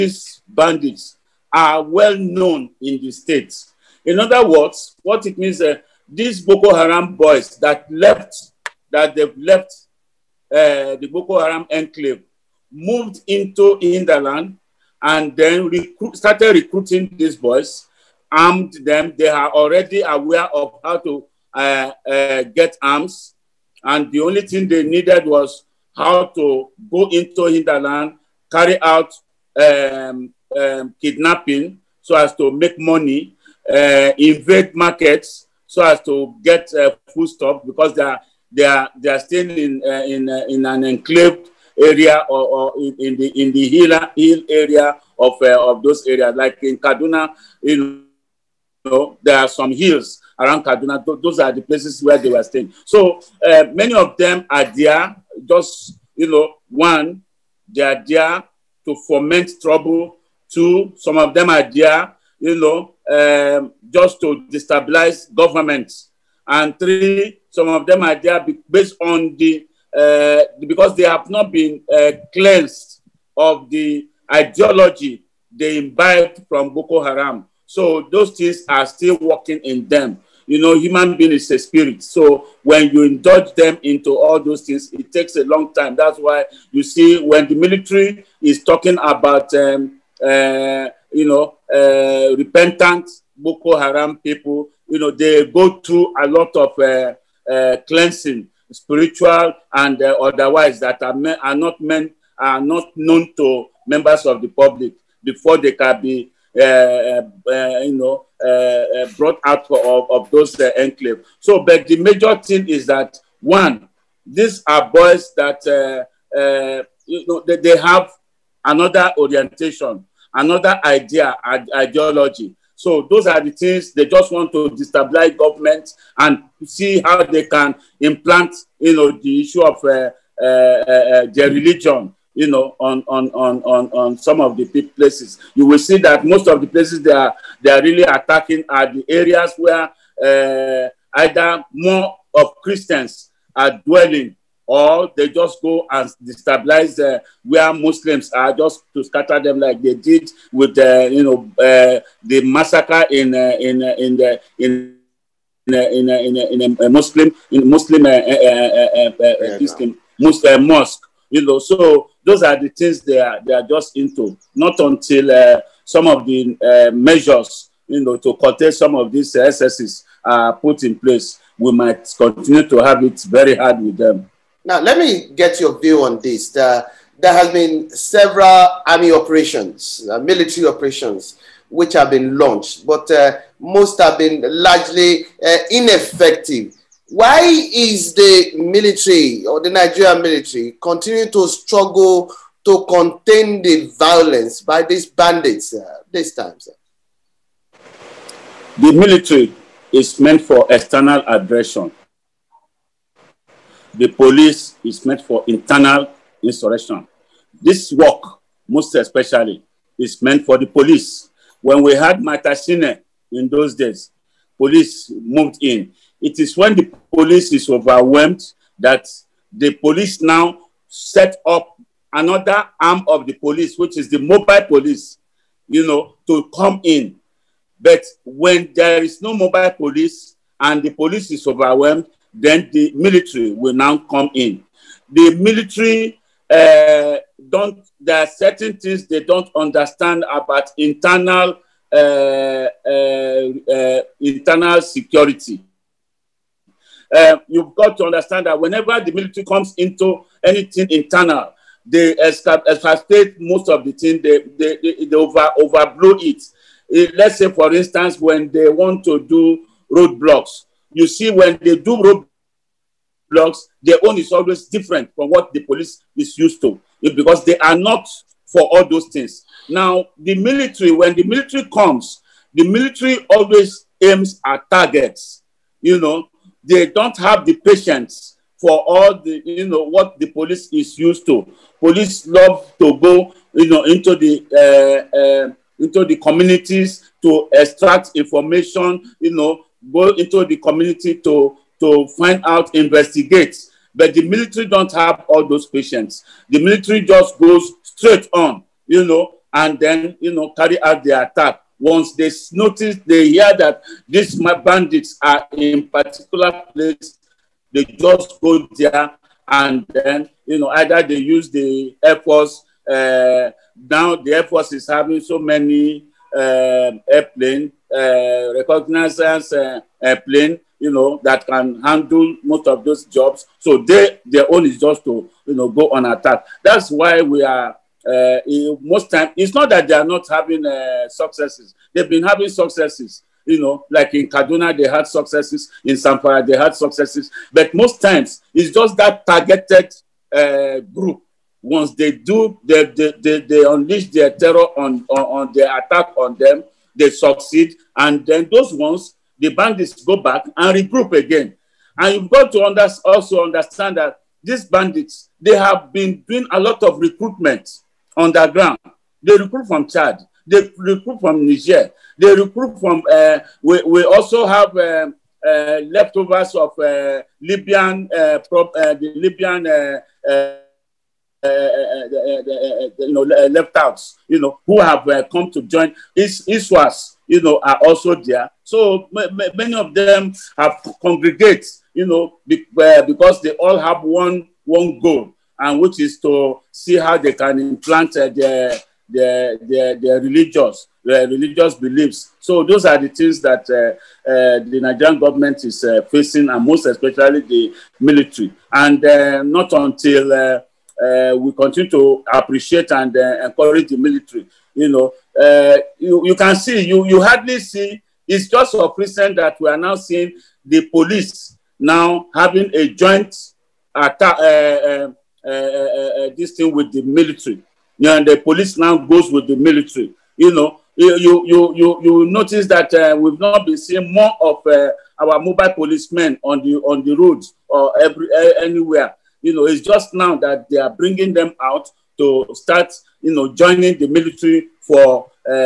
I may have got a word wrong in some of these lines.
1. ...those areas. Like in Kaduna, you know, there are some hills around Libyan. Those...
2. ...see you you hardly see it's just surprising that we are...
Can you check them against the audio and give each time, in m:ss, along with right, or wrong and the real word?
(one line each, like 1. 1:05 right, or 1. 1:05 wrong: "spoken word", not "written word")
1. 0:45 wrong: "Kaduna", not "Libyan"
2. 6:46 right.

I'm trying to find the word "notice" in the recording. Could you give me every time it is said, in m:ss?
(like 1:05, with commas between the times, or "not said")
5:02, 7:02.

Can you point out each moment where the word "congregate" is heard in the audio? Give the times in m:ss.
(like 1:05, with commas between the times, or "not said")
6:21.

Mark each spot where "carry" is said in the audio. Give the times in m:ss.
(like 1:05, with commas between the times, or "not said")
0:28, 5:00.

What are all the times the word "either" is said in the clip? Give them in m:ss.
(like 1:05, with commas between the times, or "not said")
2:21, 5:10.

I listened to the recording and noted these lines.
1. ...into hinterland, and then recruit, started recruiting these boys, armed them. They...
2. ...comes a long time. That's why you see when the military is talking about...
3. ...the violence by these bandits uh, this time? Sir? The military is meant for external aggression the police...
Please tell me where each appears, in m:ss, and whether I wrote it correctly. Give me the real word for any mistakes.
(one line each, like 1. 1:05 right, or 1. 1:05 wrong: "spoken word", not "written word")
1. 0:13 right
2. 1:25 wrong: "takes", not "comes"
3. 3:13 right.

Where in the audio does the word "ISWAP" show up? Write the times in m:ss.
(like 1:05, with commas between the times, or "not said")
6:16.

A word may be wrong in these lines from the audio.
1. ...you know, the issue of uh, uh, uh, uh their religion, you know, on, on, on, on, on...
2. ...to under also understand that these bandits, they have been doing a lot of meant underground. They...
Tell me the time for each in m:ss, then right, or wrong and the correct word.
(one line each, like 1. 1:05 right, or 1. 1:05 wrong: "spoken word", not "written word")
1. 2:08 right
2. 5:52 wrong: "recruitment", not "meant".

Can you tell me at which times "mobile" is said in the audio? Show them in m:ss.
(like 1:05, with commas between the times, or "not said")
3:44, 3:49, 7:05.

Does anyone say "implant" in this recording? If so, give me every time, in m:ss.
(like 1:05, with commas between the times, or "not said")
2:07, 6:27.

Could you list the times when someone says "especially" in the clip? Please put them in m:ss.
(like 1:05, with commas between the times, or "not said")
3:28, 6:36.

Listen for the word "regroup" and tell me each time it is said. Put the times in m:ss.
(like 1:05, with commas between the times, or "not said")
5:50.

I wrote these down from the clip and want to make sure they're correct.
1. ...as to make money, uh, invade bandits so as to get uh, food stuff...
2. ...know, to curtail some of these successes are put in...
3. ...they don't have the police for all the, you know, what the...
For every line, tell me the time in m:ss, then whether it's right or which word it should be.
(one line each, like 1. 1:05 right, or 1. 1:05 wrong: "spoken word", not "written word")
1. 0:32 wrong: "markets", not "bandits"
2. 2:47 wrong: "excesses", not "successes"
3. 4:36 wrong: "patience", not "police".